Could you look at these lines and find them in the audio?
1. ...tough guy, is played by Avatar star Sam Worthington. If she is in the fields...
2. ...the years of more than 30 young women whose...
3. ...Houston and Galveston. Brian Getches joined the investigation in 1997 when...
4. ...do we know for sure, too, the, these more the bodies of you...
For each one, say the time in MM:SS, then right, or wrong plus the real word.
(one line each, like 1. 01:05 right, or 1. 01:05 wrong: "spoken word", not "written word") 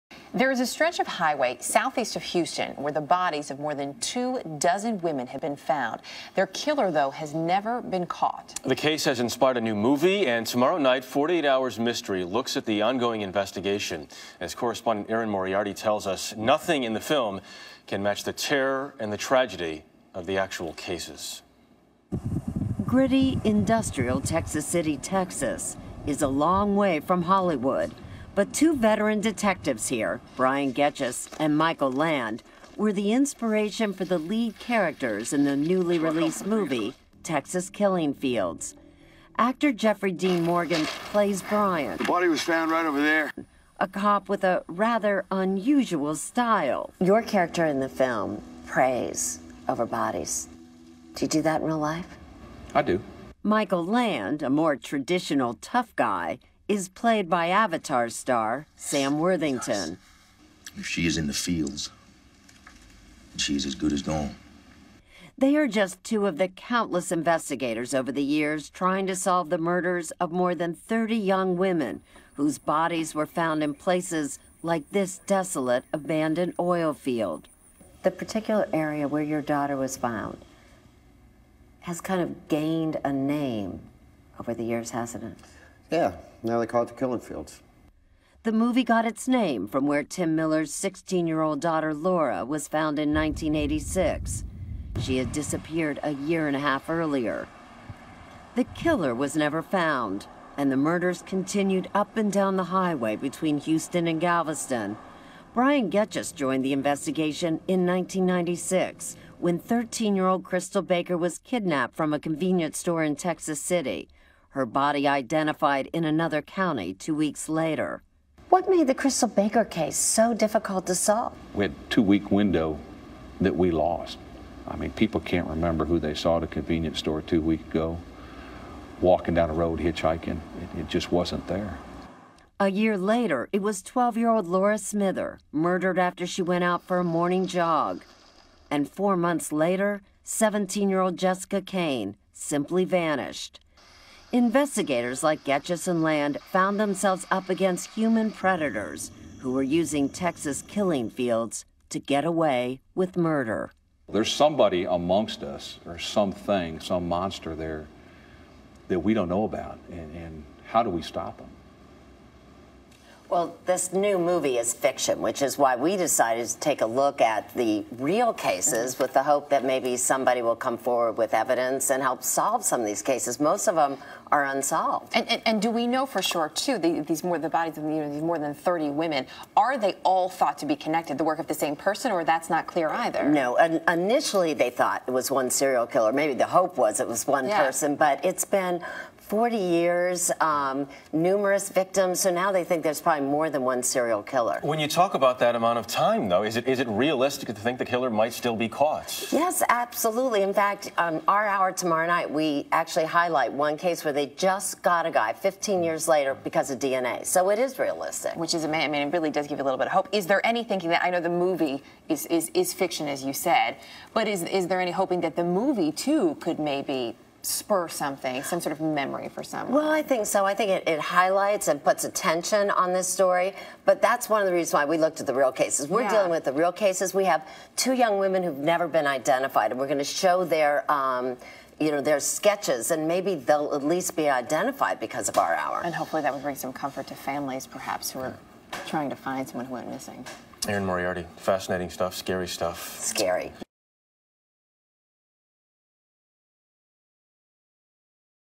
1. 00:55 right
2. 01:09 wrong: "murders", not "years"
3. 01:43 wrong: "1996", not "1997"
4. 02:55 right.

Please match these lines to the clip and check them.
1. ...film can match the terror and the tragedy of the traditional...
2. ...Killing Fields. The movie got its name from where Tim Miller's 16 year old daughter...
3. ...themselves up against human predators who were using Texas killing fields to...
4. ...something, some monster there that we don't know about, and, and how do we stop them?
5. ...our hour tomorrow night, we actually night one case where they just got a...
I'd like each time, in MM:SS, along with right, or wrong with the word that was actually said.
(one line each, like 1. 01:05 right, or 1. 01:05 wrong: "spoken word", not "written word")
1. 00:17 wrong: "actual", not "traditional"
2. 01:26 right
3. 02:26 right
4. 02:35 right
5. 03:21 wrong: "highlight", not "night".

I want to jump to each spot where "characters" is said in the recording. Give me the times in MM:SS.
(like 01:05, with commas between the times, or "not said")
00:34, 00:47.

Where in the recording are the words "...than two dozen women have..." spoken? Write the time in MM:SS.
00:03.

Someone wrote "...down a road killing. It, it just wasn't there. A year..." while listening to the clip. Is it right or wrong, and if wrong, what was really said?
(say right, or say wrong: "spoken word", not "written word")
wrong: "hitchhiking", not "killing".